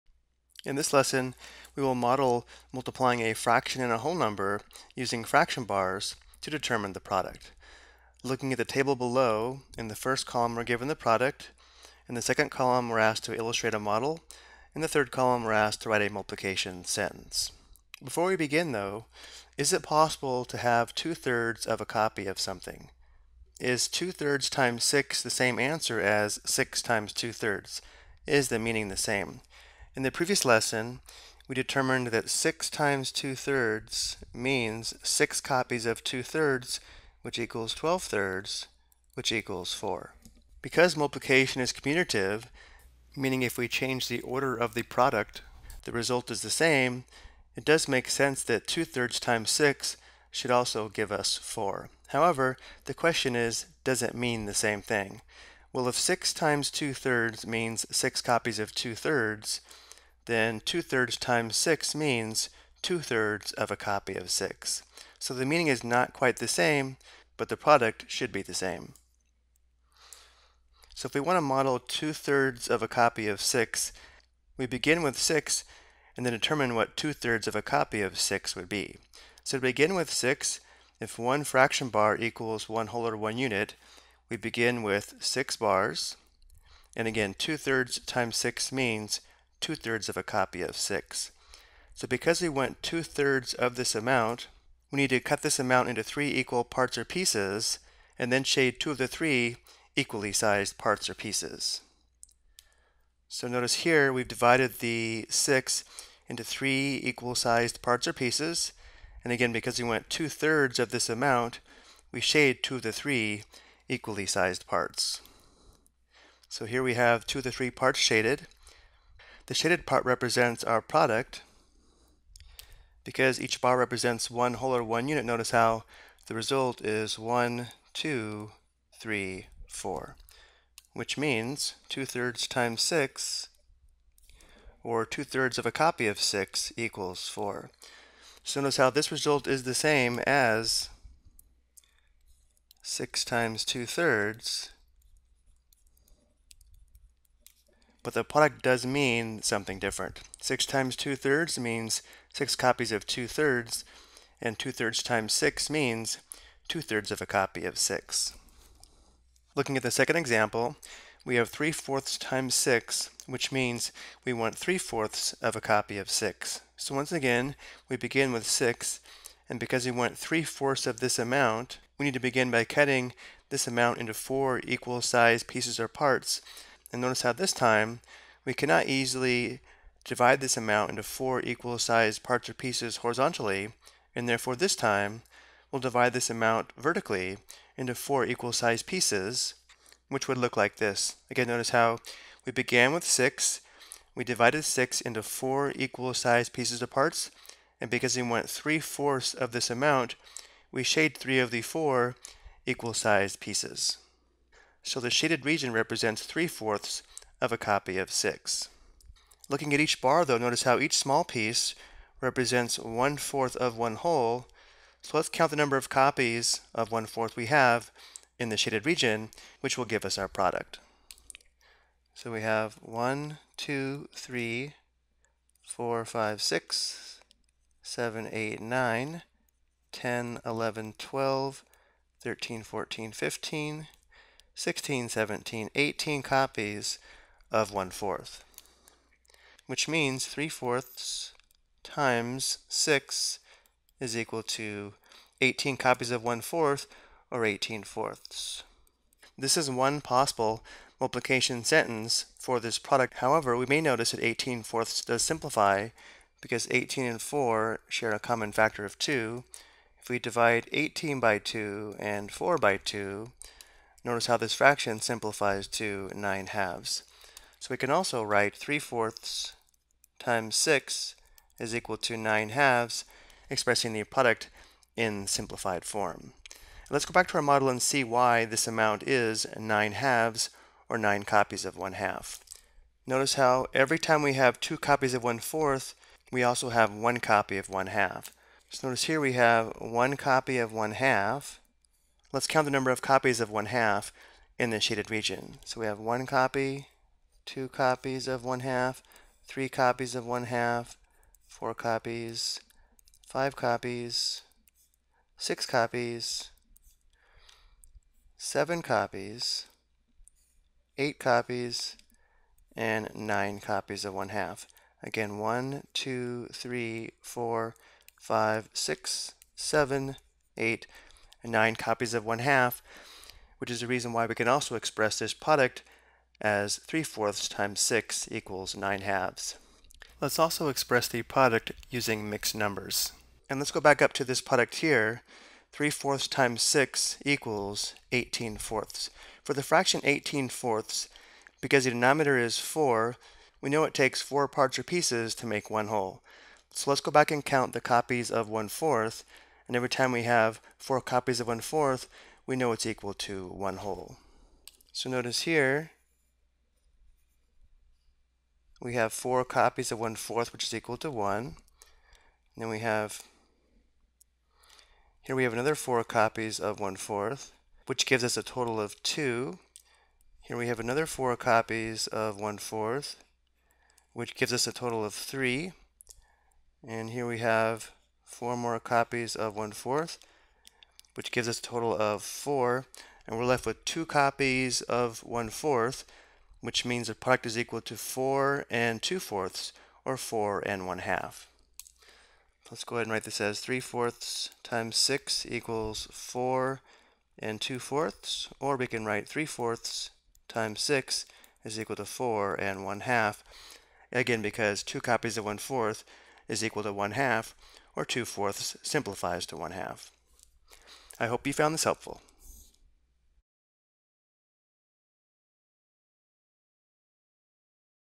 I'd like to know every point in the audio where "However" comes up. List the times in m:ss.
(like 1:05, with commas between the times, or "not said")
0:52, 4:13.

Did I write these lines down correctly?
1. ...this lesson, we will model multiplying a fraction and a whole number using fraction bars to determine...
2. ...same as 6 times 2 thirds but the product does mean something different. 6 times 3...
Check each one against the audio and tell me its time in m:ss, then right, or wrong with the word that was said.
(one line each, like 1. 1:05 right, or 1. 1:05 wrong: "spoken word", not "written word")
1. 0:00 right
2. 2:19 wrong: "2", not "3".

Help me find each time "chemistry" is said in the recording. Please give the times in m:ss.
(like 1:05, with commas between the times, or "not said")
not said.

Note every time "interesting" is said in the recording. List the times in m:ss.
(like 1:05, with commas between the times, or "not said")
not said.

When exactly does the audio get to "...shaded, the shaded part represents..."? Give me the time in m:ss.
1:57.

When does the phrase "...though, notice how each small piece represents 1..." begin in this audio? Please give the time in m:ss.
3:30.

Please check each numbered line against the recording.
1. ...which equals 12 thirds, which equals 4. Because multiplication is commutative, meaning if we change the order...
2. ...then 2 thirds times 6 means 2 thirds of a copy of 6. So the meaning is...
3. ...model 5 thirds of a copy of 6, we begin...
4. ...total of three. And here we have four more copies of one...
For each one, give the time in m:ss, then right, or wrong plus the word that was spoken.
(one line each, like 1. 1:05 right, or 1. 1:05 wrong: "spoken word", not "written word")
1. 0:37 right
2. 1:00 right
3. 1:11 wrong: "2", not "5"
4. 6:14 right.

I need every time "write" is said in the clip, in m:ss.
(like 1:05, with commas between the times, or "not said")
0:15, 4:28, 6:33, 6:39.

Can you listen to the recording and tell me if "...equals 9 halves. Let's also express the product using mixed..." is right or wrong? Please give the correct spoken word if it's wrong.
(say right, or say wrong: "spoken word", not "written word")
right.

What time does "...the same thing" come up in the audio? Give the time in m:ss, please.
0:54.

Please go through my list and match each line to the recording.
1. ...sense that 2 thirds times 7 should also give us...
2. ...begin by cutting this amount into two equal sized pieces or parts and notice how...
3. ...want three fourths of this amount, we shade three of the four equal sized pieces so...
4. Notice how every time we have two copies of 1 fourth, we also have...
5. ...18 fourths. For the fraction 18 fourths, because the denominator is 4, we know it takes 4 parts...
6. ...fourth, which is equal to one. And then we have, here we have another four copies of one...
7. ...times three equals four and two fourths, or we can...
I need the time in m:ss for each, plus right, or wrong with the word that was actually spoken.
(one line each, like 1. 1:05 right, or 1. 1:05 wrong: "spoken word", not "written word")
1. 0:48 wrong: "6", not "7"
2. 2:52 wrong: "four", not "two"
3. 3:18 right
4. 4:43 right
5. 5:38 right
6. 6:00 right
7. 6:34 wrong: "six", not "three".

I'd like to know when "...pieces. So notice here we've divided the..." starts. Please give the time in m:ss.
1:41.